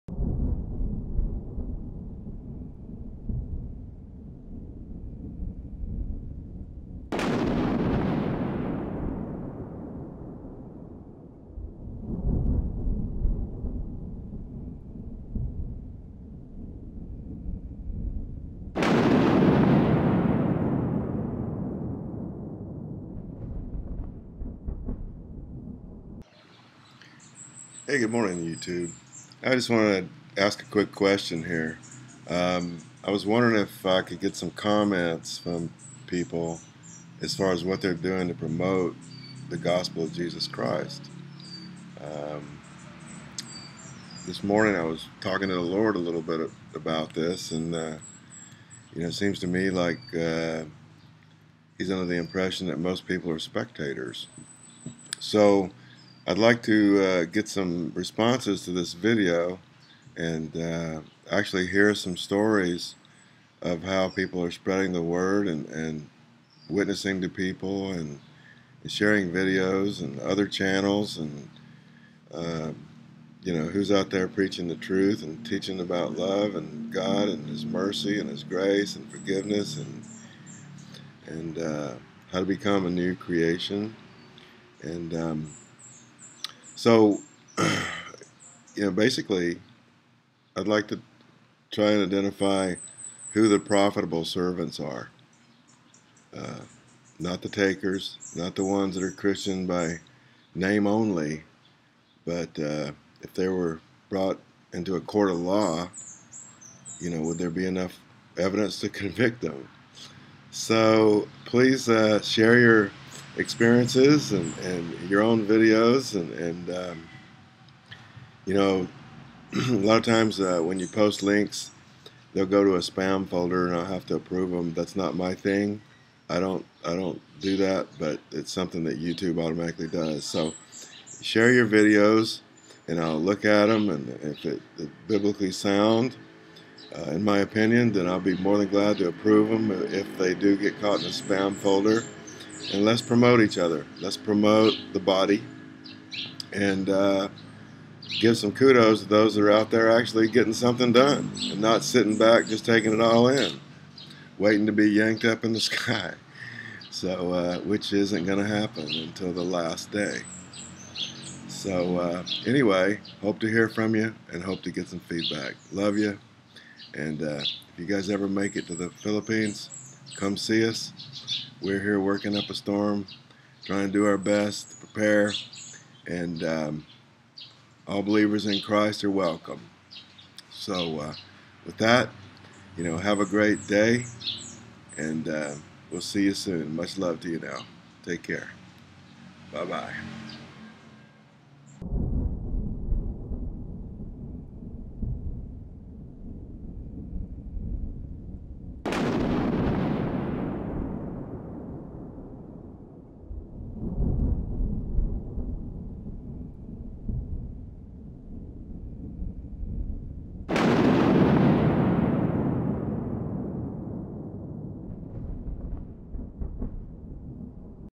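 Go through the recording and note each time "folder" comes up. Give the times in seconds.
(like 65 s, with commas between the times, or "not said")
123 s, 141 s.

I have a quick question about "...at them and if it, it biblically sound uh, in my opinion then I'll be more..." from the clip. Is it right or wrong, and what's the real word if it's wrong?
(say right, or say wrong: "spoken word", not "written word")
right.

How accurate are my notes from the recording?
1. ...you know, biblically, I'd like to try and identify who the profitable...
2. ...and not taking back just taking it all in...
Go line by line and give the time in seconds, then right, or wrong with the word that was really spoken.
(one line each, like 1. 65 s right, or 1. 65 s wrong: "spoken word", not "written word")
1. 88 s wrong: "basically", not "biblically"
2. 151 s wrong: "sitting", not "taking".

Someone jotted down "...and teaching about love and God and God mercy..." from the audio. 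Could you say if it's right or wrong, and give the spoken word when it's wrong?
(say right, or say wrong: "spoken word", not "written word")
wrong: "His", not "God".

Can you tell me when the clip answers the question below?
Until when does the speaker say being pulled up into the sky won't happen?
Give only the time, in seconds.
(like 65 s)
159 s.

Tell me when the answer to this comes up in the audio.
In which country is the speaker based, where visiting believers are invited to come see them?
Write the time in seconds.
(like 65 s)
168 s.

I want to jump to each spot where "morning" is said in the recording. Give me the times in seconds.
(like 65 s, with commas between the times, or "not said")
28 s, 44 s.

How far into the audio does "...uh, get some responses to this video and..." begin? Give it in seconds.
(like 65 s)
57 s.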